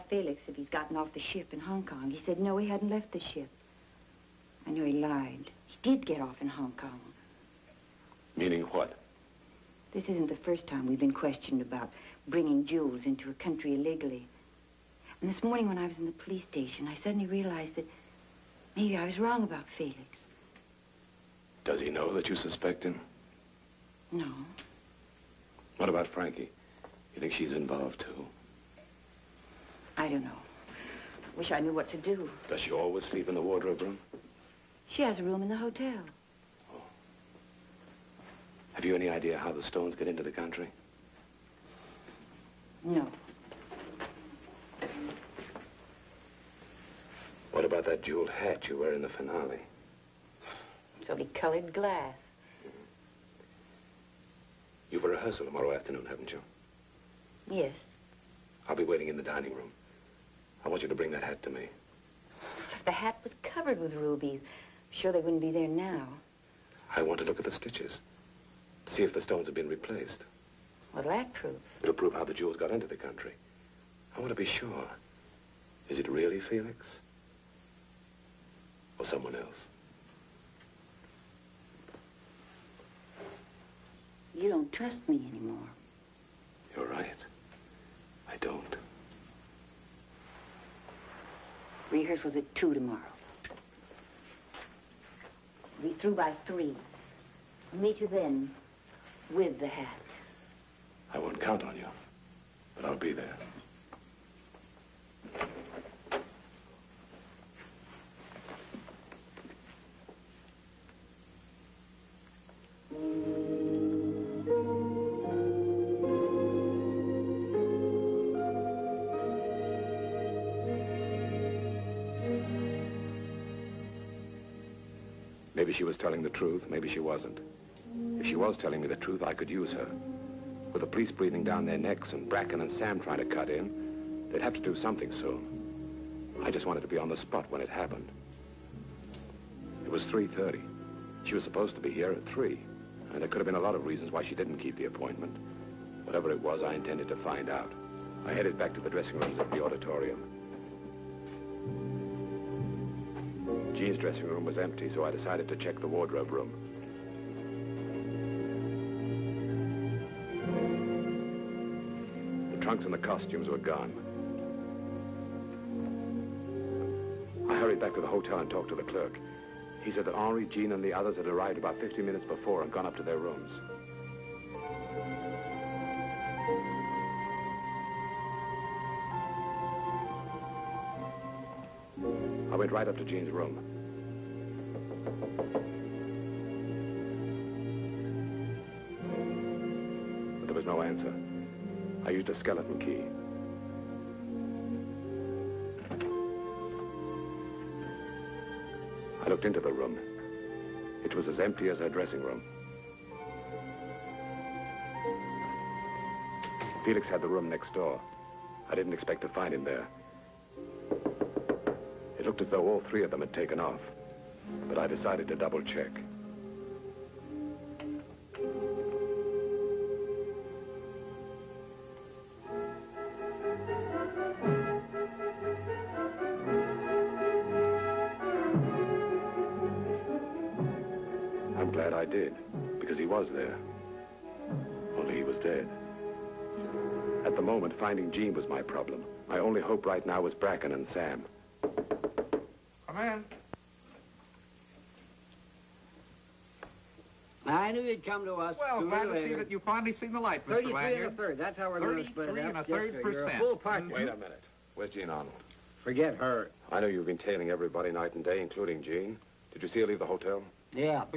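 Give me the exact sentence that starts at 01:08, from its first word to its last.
See if the stones have been replaced.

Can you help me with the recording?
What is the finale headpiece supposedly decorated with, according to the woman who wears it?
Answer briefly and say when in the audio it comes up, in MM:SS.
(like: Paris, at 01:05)
Colored glass, at 00:51.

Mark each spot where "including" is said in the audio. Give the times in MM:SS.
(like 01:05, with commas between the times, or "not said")
04:18.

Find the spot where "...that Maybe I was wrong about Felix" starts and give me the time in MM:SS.
00:17.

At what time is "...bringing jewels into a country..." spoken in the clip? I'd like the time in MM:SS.
00:12.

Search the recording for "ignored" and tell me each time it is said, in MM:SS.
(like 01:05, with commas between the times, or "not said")
not said.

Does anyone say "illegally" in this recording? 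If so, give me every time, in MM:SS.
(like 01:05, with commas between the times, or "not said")
00:13.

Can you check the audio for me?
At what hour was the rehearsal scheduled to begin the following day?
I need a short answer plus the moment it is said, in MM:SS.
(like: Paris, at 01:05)
2, at 01:32.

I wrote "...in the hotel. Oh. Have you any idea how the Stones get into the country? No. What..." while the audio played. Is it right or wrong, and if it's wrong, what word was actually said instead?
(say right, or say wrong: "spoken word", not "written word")
right.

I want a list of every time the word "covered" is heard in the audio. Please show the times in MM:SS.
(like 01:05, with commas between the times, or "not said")
01:03.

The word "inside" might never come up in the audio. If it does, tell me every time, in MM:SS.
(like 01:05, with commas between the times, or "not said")
not said.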